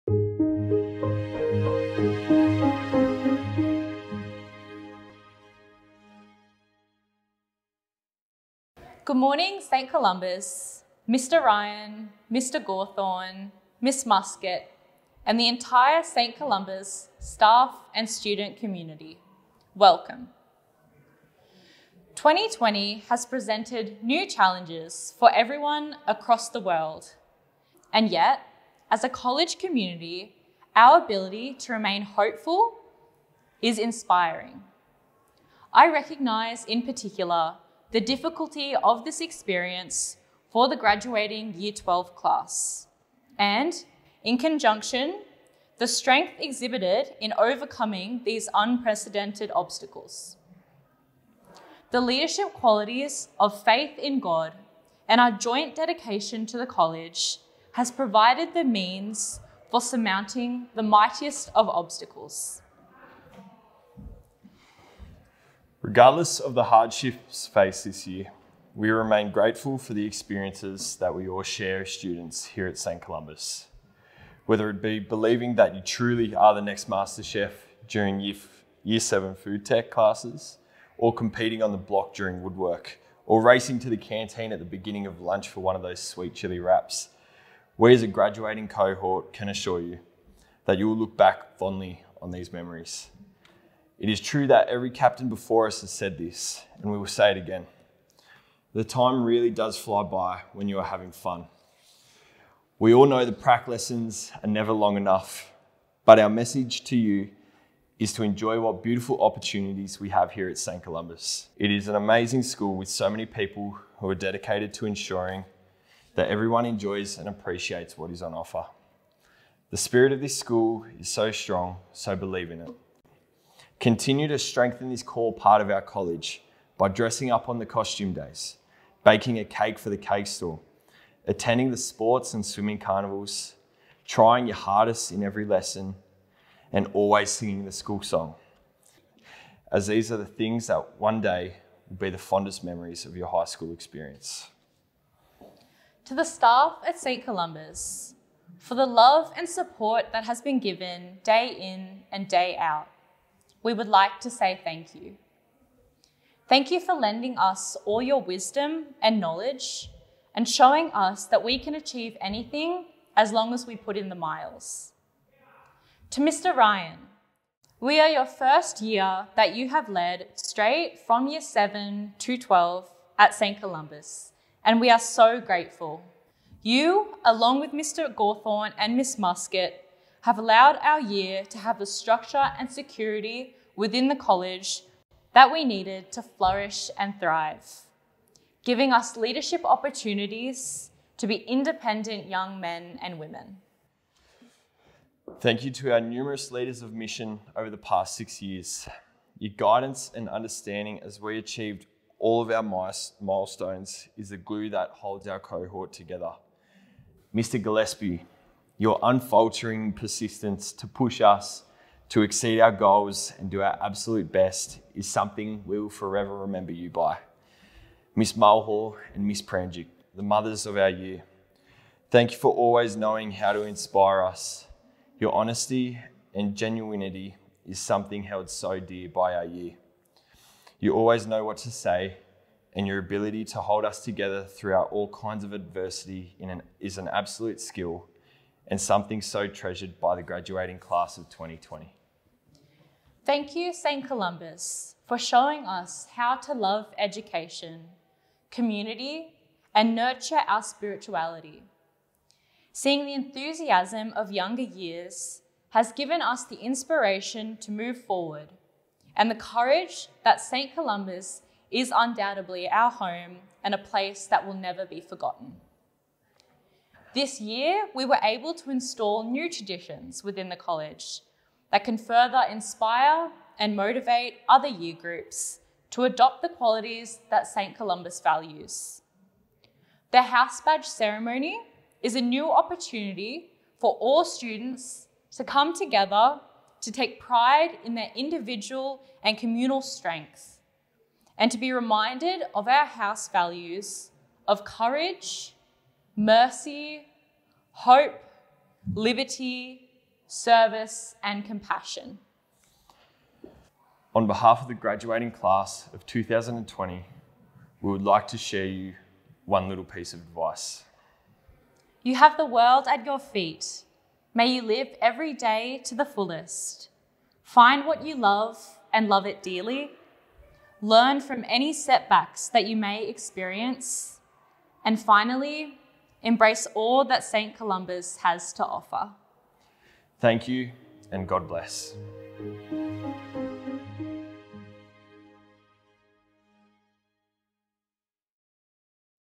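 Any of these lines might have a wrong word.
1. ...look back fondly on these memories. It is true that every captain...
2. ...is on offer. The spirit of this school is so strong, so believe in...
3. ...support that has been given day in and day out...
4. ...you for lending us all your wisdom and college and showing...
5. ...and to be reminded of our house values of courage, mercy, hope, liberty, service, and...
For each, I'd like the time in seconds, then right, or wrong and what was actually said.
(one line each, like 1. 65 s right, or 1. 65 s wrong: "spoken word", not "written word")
1. 90 s right
2. 118 s right
3. 149 s right
4. 156 s wrong: "knowledge", not "college"
5. 291 s right.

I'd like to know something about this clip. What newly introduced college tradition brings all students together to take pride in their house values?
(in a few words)
house badge ceremony.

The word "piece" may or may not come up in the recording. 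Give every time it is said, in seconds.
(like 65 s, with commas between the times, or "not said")
309 s.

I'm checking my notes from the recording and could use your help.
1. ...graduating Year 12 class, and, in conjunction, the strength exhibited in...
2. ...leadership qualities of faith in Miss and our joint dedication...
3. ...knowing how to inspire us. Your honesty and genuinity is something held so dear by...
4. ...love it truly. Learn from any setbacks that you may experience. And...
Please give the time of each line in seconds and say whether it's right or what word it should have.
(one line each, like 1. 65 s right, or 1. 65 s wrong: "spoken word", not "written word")
1. 40 s right
2. 52 s wrong: "God", not "Miss"
3. 222 s right
4. 319 s wrong: "dearly", not "truly".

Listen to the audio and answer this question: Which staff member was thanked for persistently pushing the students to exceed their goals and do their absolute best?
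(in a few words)
Mr. Gillespie.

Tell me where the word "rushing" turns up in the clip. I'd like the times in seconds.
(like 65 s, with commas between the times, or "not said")
not said.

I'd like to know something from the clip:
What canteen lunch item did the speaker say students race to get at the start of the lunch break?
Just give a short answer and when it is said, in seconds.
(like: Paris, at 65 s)
sweet chili wraps, at 85 s.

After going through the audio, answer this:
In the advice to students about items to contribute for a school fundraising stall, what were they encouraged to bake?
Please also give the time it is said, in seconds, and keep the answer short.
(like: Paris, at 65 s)
a cake, at 129 s.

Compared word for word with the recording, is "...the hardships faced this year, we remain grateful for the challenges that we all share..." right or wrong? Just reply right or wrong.
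wrong.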